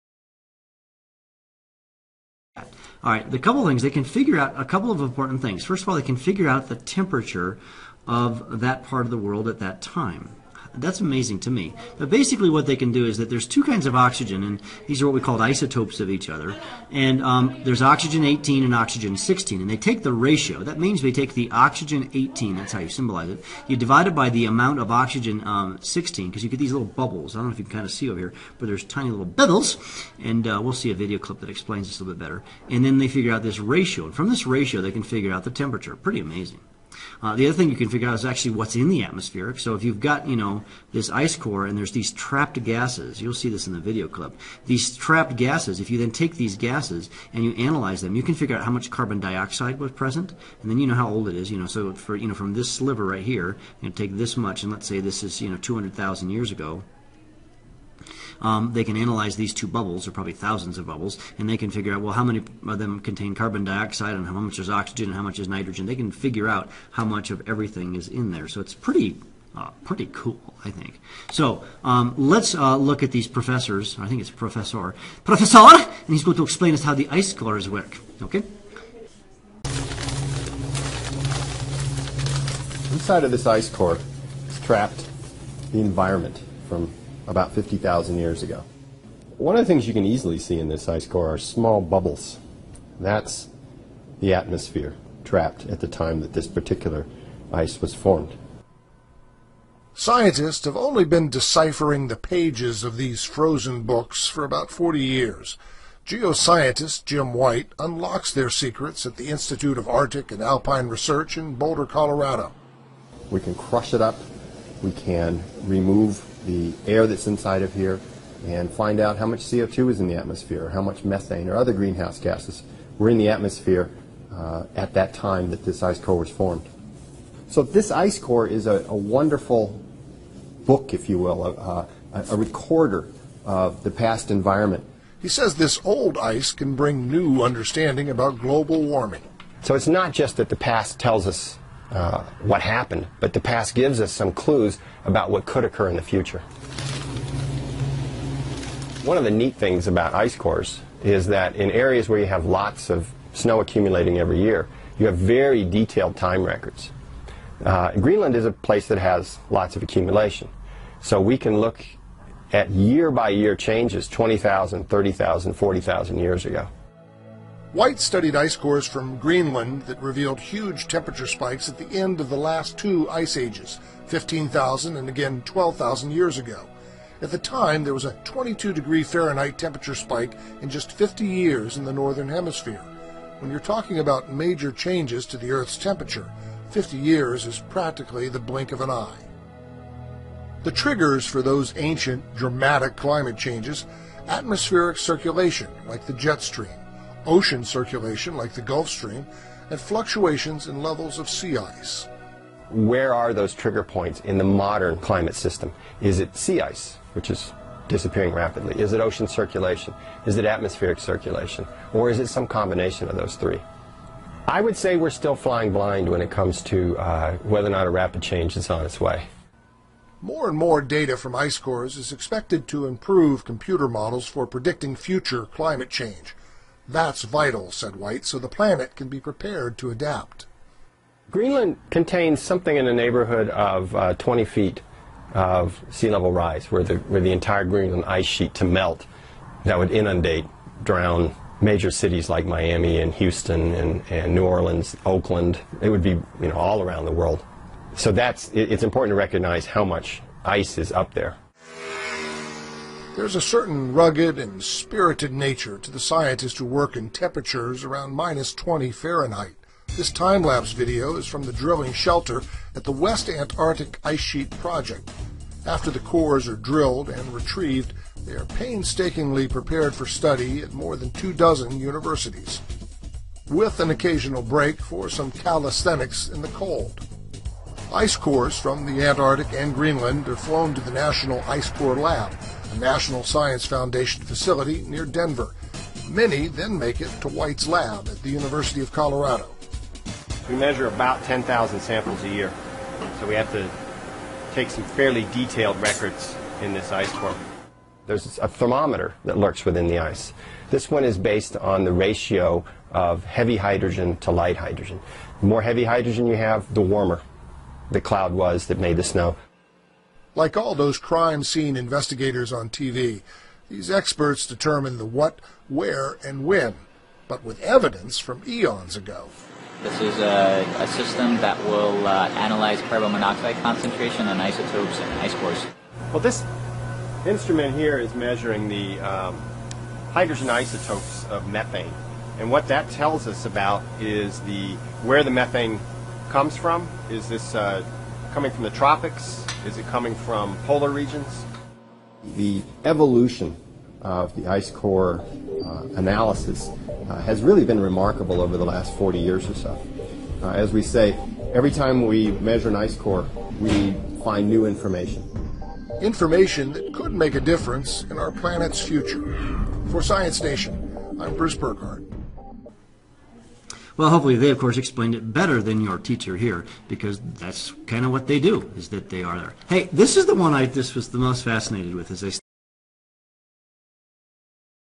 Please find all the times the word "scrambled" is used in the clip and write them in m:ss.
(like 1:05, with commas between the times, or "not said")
not said.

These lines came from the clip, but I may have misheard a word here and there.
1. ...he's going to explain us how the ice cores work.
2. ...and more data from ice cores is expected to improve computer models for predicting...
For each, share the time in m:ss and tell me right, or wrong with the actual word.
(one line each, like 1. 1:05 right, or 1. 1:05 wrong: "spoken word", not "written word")
1. 1:16 right
2. 3:40 right.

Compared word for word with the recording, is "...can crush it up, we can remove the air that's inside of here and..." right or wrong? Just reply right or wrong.
right.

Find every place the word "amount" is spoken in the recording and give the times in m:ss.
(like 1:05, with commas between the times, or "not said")
0:24.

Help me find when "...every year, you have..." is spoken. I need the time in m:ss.
2:34.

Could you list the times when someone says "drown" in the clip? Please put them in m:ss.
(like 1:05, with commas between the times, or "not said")
4:00.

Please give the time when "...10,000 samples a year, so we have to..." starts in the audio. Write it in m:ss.
4:51.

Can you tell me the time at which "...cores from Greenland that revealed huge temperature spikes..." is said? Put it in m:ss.
2:48.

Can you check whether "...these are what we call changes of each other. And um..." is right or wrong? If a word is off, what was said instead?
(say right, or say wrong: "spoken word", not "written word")
wrong: "isotopes", not "changes".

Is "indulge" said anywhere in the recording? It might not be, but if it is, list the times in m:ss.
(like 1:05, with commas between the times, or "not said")
not said.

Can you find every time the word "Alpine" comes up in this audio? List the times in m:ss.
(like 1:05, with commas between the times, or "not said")
1:50.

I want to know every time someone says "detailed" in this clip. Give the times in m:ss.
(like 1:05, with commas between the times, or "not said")
2:35, 4:55.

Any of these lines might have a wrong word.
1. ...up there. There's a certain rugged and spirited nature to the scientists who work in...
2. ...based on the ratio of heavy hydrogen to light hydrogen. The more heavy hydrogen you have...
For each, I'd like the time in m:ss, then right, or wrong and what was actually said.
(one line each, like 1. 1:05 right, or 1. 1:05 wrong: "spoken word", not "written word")
1. 4:10 right
2. 5:01 right.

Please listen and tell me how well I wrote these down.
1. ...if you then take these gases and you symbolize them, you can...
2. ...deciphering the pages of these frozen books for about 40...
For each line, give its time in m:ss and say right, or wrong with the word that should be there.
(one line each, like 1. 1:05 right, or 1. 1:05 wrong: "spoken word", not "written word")
1. 0:45 wrong: "analyze", not "symbolize"
2. 1:41 right.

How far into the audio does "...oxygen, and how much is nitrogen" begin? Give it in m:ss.
1:04.